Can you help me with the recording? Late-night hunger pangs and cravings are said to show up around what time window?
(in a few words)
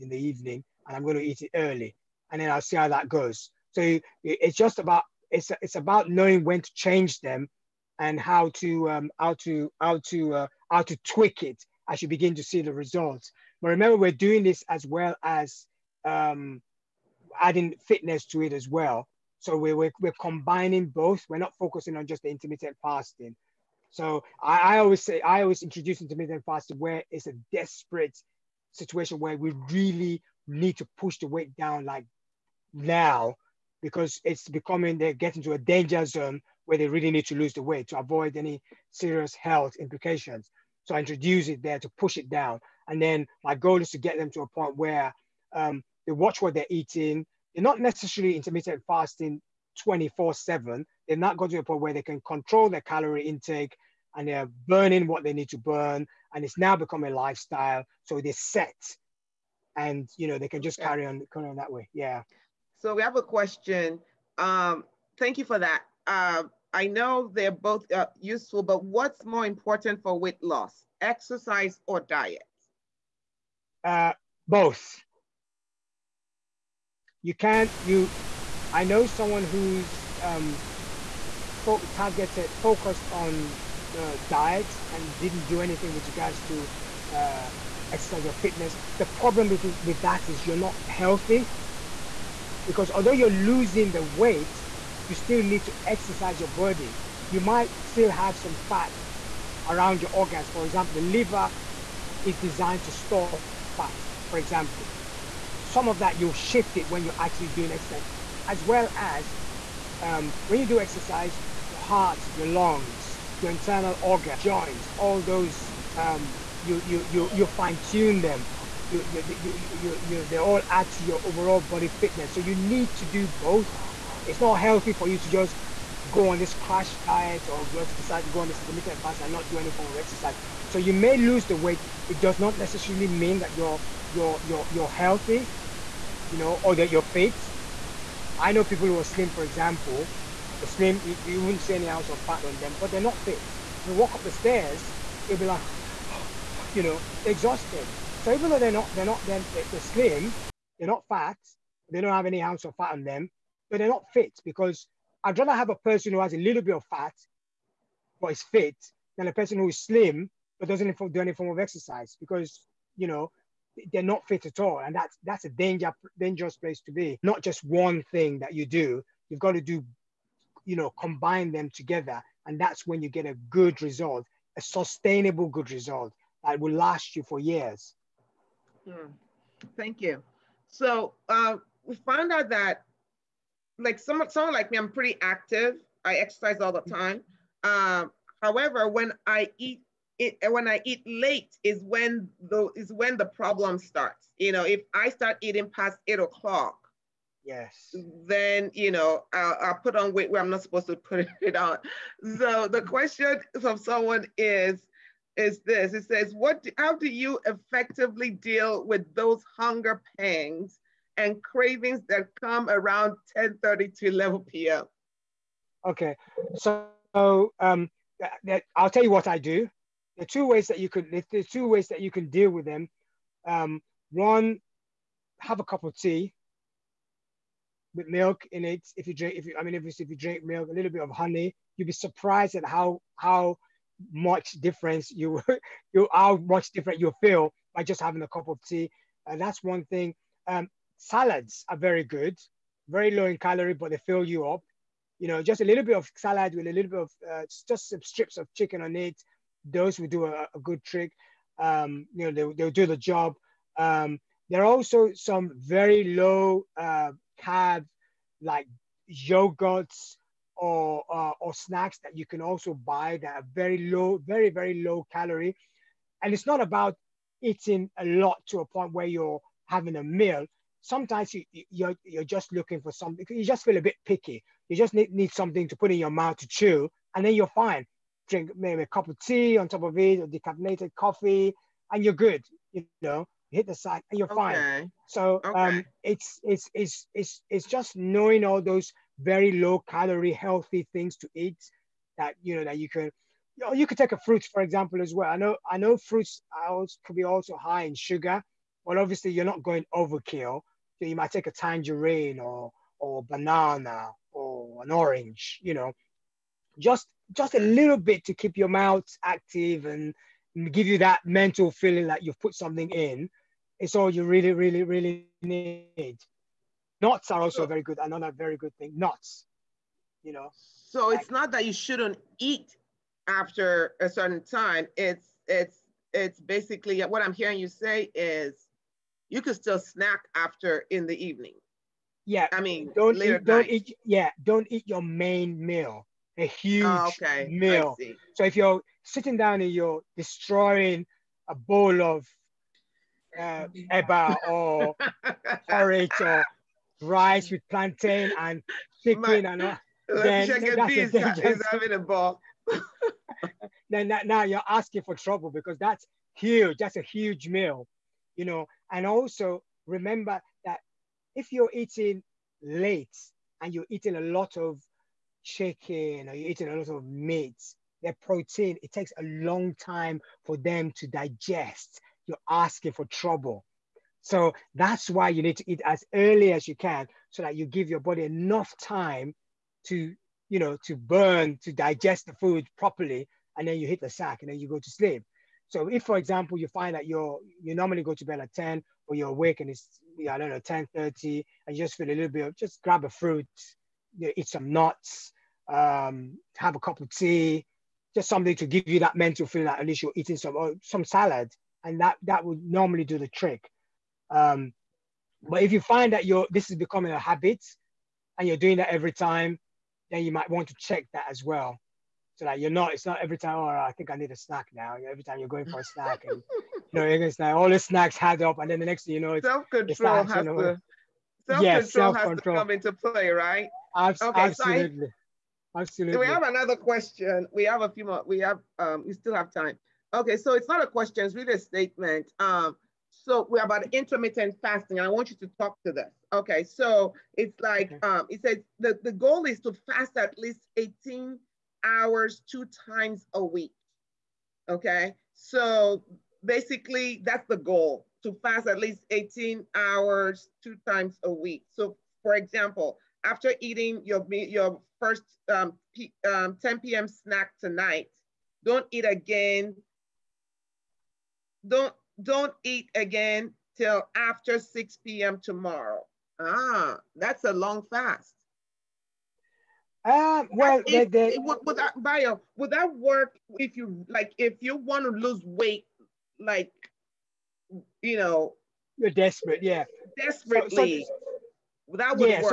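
10:30 to 11 p.m.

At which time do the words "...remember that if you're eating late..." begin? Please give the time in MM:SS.
05:59.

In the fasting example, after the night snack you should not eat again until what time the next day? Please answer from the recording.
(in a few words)
6 p.m.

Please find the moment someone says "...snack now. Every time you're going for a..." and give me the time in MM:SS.
06:54.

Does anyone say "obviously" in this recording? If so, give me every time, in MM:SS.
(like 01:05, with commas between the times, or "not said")
03:49, 04:58.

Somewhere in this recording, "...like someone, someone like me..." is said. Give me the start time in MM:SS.
03:03.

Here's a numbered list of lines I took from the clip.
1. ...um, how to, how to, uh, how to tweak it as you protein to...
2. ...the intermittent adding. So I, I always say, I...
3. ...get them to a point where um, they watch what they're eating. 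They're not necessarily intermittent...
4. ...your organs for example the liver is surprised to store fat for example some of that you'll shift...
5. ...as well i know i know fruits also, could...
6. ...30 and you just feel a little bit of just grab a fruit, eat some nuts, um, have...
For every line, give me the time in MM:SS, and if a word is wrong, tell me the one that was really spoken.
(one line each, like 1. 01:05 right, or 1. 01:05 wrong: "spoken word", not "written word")
1. 00:08 wrong: "begin", not "protein"
2. 00:22 wrong: "fasting", not "adding"
3. 00:43 right
4. 01:40 wrong: "designed", not "surprised"
5. 04:55 right
6. 06:30 right.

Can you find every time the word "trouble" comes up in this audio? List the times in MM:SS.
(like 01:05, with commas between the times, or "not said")
05:55, 06:13.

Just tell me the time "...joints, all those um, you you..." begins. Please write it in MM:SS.
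01:54.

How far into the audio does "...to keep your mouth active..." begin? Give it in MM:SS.
05:08.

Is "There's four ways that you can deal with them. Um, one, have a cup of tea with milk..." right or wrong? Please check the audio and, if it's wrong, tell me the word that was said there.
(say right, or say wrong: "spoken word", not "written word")
wrong: "two", not "four".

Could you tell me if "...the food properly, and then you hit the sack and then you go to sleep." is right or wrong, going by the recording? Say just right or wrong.
right.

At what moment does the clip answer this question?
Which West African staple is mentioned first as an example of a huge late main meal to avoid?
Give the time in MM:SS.
05:43.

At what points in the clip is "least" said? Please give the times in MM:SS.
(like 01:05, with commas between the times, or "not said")
06:39, 07:20, 07:28.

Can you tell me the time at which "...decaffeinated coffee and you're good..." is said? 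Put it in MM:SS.
04:40.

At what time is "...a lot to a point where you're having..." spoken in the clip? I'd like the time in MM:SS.
04:27.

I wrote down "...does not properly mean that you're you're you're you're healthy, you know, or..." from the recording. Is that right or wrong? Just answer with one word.
wrong.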